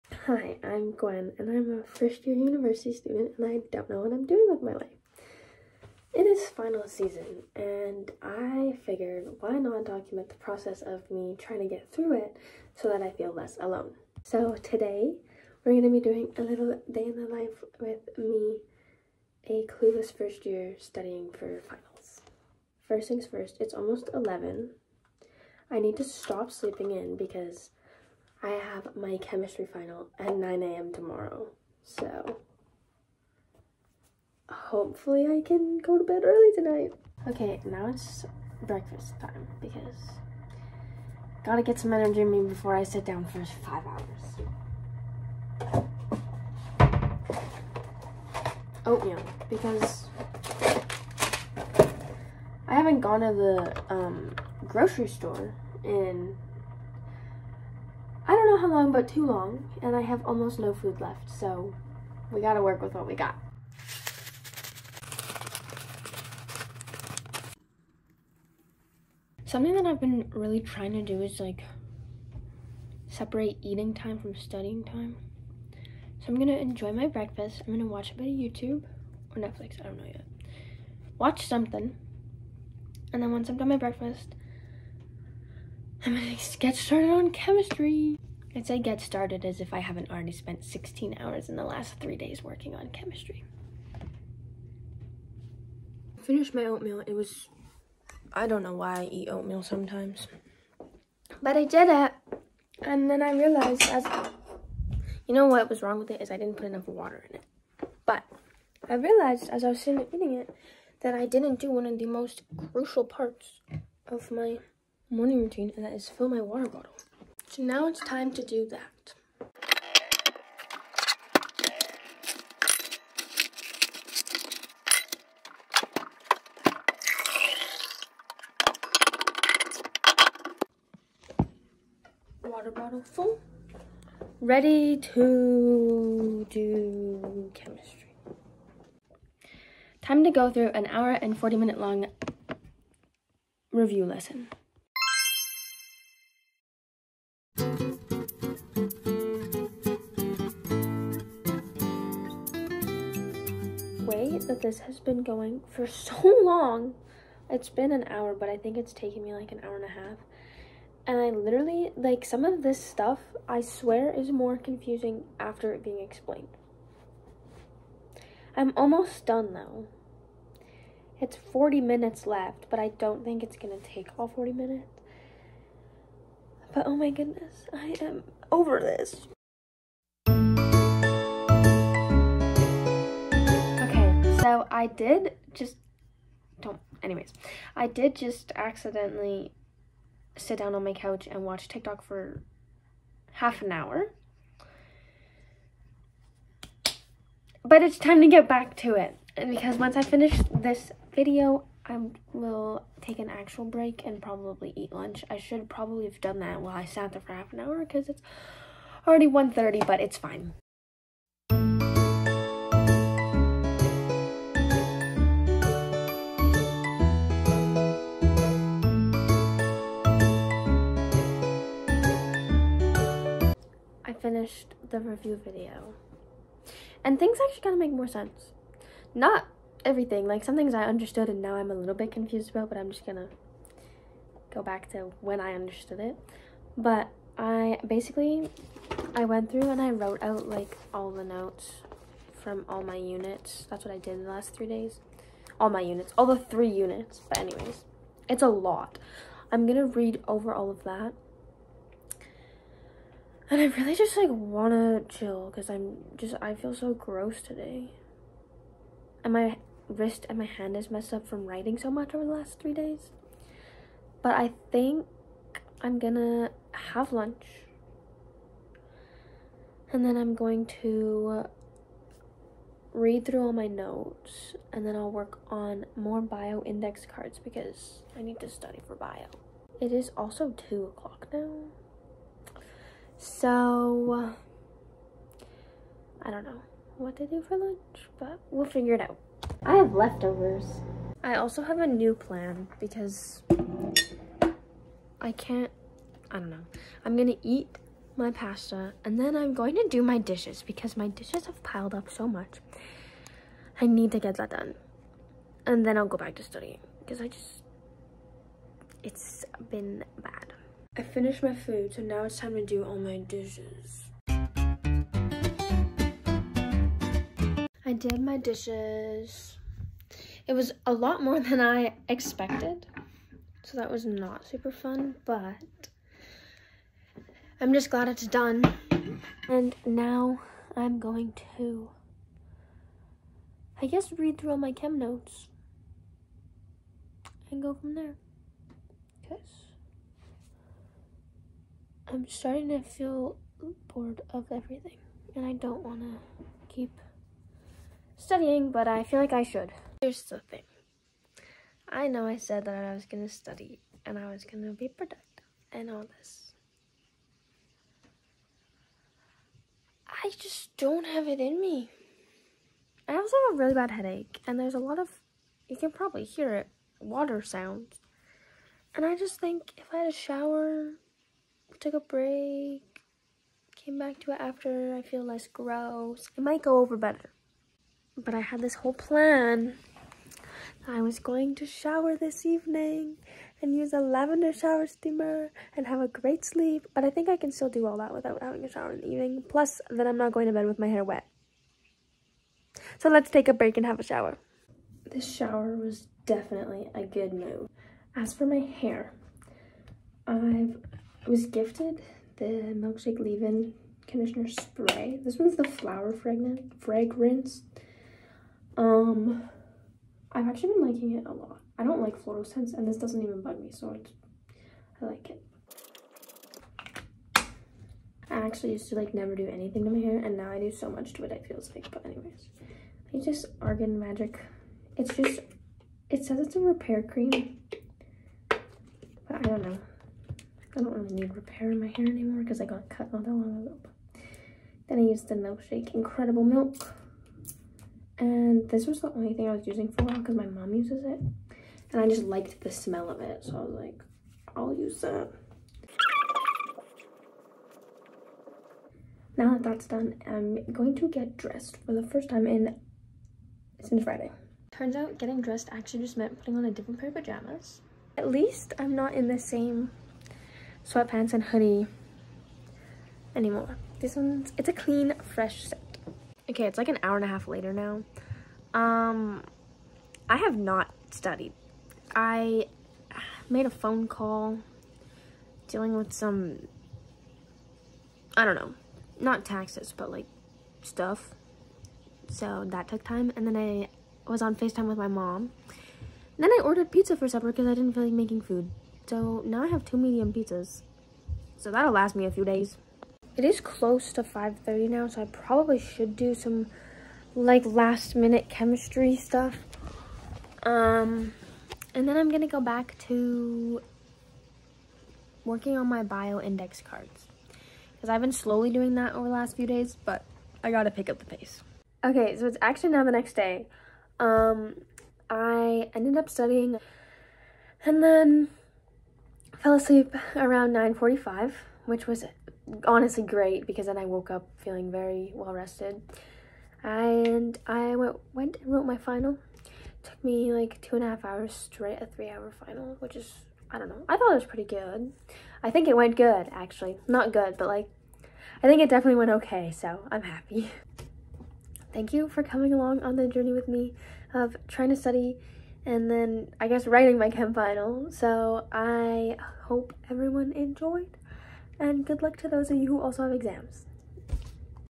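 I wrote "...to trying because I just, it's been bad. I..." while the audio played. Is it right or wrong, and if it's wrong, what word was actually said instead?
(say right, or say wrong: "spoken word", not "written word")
wrong: "studying", not "trying".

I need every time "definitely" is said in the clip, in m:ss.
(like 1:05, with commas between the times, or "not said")
6:36, 8:58.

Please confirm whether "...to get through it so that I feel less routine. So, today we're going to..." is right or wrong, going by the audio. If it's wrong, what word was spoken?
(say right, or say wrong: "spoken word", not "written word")
wrong: "alone", not "routine".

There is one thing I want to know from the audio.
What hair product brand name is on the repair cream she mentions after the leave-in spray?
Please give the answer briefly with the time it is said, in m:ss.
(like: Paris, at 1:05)
Argan Magic, at 7:03.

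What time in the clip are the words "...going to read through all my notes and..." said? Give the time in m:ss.
4:30.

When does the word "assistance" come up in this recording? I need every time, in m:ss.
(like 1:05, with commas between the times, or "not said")
not said.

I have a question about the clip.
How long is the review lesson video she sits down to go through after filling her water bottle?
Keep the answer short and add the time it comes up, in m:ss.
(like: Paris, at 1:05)
an hour and 40 minutes, at 2:20.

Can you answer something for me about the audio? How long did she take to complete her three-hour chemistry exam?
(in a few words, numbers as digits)
two and a half hours.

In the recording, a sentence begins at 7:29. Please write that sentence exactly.
Now that that's done, I'm going to get dressed for the first time in since Friday.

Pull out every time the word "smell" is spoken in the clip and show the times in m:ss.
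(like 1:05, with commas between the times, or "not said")
7:22.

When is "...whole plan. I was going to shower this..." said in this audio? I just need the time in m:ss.
6:18.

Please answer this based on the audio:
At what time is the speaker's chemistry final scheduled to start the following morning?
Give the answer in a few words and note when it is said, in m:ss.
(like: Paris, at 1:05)
9 a.m., at 0:30.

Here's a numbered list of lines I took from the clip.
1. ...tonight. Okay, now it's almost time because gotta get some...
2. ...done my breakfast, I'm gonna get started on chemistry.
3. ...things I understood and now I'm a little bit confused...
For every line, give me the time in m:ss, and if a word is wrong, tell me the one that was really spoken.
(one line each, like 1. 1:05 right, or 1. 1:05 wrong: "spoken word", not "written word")
1. 0:36 wrong: "breakfast", not "almost"
2. 1:23 right
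3. 3:50 right.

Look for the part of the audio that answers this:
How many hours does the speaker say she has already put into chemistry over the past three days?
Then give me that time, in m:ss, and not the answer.
1:30.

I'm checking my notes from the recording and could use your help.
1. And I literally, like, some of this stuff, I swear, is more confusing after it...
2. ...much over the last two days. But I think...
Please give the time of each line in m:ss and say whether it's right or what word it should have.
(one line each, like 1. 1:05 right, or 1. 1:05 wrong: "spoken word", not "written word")
1. 2:41 right
2. 4:21 wrong: "three", not "two".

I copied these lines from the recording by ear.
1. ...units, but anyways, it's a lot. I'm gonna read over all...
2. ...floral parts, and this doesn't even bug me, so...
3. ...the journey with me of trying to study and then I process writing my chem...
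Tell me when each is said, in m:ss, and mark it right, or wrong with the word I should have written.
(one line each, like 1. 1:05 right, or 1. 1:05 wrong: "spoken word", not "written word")
1. 4:06 right
2. 6:52 wrong: "scents", not "parts"
3. 9:03 wrong: "guess", not "process".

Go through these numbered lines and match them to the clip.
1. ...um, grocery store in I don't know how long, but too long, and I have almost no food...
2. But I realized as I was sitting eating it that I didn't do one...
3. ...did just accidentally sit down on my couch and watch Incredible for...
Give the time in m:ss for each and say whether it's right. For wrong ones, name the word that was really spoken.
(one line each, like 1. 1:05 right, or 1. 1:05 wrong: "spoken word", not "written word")
1. 0:53 right
2. 1:48 right
3. 3:07 wrong: "TikTok", not "Incredible".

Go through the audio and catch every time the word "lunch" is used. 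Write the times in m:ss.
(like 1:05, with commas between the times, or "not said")
3:24, 4:27, 4:47.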